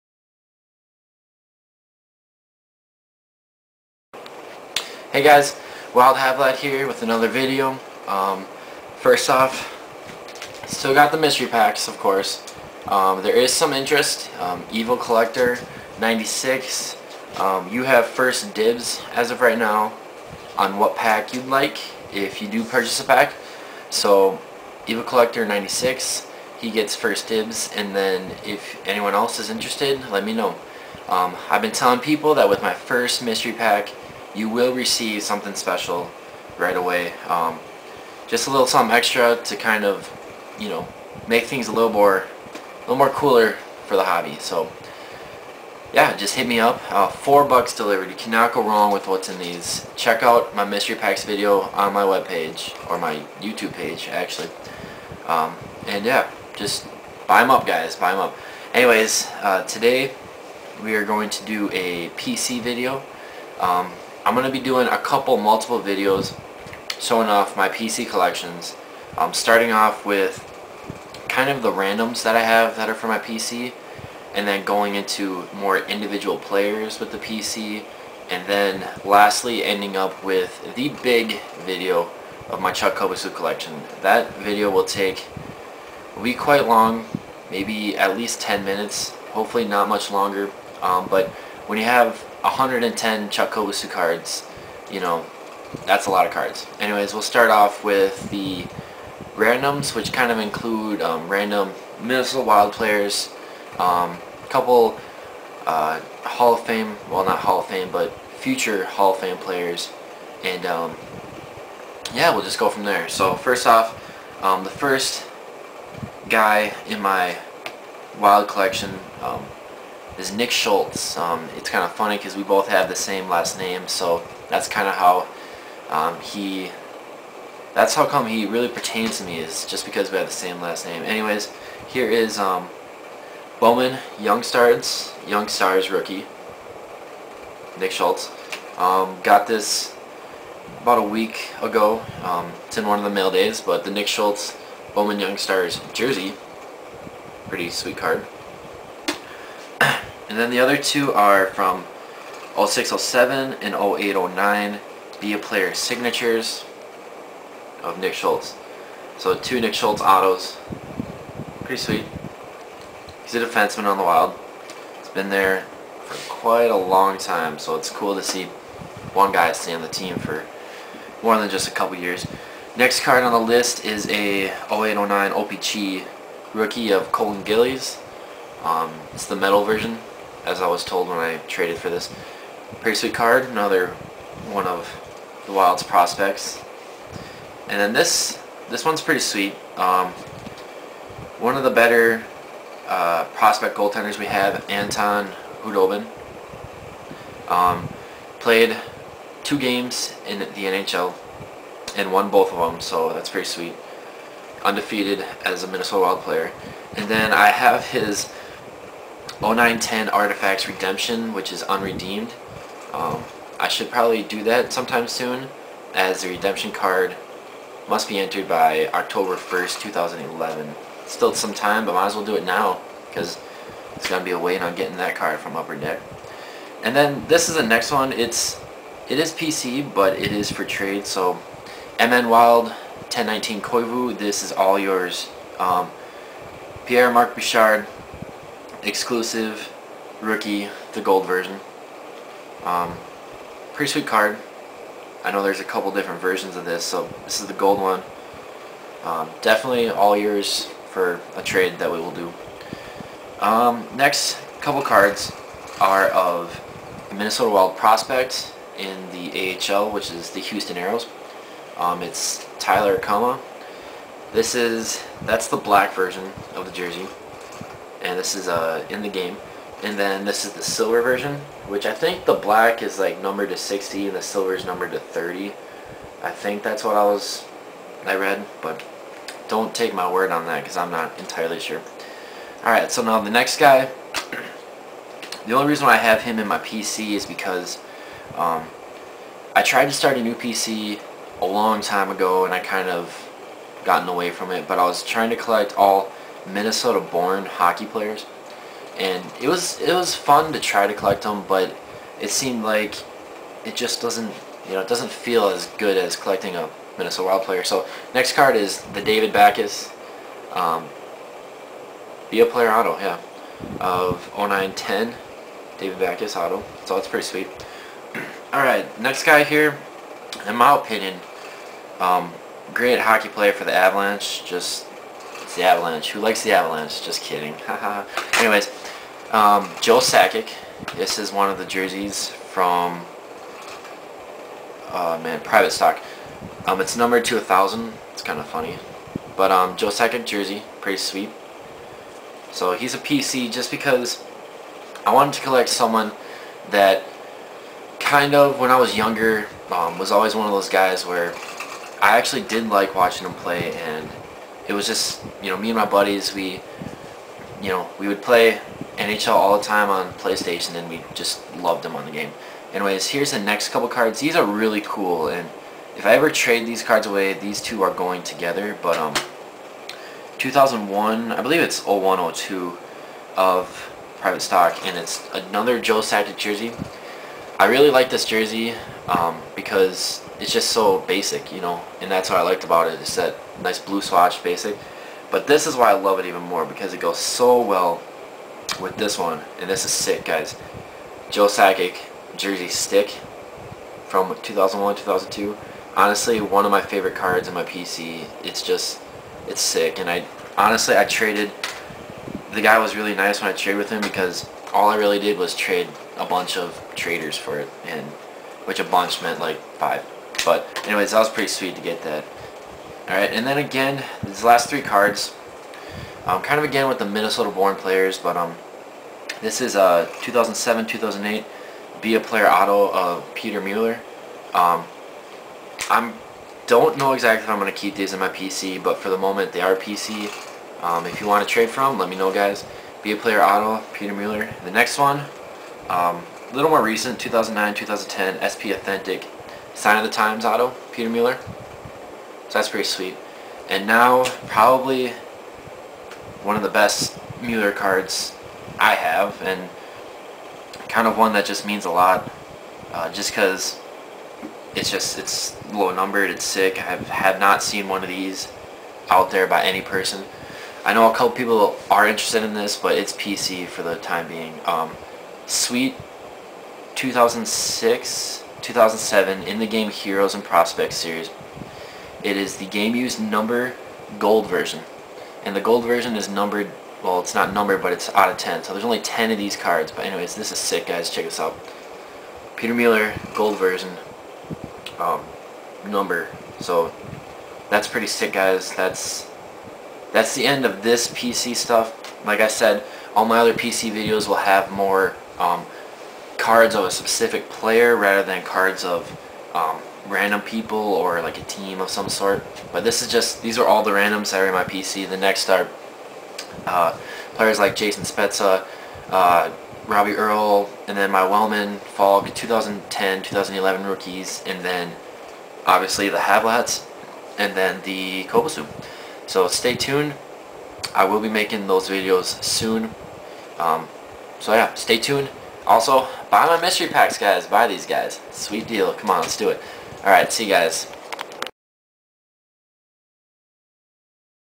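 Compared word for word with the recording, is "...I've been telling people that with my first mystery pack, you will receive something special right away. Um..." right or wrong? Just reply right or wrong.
right.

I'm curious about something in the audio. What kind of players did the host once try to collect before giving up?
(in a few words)
Minnesota-born hockey players.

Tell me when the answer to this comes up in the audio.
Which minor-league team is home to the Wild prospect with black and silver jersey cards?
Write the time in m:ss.
4:20.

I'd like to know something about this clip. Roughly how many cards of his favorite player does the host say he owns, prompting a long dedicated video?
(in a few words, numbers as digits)
110.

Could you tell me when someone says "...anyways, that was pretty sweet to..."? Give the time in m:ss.
6:50.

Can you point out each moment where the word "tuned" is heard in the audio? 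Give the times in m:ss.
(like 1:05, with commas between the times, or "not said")
8:39, 8:44.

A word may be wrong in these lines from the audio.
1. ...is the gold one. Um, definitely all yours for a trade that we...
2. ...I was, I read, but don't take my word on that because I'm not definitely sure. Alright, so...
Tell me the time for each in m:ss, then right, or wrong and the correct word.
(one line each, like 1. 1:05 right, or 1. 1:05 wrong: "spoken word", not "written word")
1. 4:07 right
2. 4:36 wrong: "entirely", not "definitely".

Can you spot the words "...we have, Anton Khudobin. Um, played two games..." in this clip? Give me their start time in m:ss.
3:14.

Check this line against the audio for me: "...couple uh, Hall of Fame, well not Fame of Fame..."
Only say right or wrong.
wrong.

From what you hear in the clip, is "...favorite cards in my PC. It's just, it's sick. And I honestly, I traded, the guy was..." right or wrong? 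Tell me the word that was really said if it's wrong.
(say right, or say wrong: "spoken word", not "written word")
right.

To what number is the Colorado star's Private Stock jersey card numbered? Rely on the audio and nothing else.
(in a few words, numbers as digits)
1000.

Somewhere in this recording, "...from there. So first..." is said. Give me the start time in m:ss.
1:52.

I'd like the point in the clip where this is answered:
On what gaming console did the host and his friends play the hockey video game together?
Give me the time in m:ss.
6:00.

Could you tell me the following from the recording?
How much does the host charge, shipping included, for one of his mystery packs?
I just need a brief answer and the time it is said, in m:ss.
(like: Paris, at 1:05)
$4, at 0:47.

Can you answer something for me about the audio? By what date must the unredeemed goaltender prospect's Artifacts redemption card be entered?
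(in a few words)
October 1st, 2011.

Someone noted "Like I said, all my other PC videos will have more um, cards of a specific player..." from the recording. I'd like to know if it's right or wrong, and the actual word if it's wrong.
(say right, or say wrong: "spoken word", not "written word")
right.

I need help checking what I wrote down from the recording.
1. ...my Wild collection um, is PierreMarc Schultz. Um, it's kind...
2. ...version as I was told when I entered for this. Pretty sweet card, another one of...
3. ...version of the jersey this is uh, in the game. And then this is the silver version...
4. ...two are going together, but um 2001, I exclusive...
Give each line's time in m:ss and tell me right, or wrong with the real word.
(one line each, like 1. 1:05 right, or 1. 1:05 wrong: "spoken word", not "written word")
1. 1:56 wrong: "Nick", not "PierreMarc"
2. 2:59 wrong: "traded", not "entered"
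3. 4:25 right
4. 6:07 wrong: "believe", not "exclusive".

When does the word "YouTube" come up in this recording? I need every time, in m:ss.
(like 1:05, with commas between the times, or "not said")
0:53.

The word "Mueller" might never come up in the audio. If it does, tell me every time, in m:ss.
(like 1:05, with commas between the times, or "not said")
7:03, 7:14, 7:21, 7:27, 8:02.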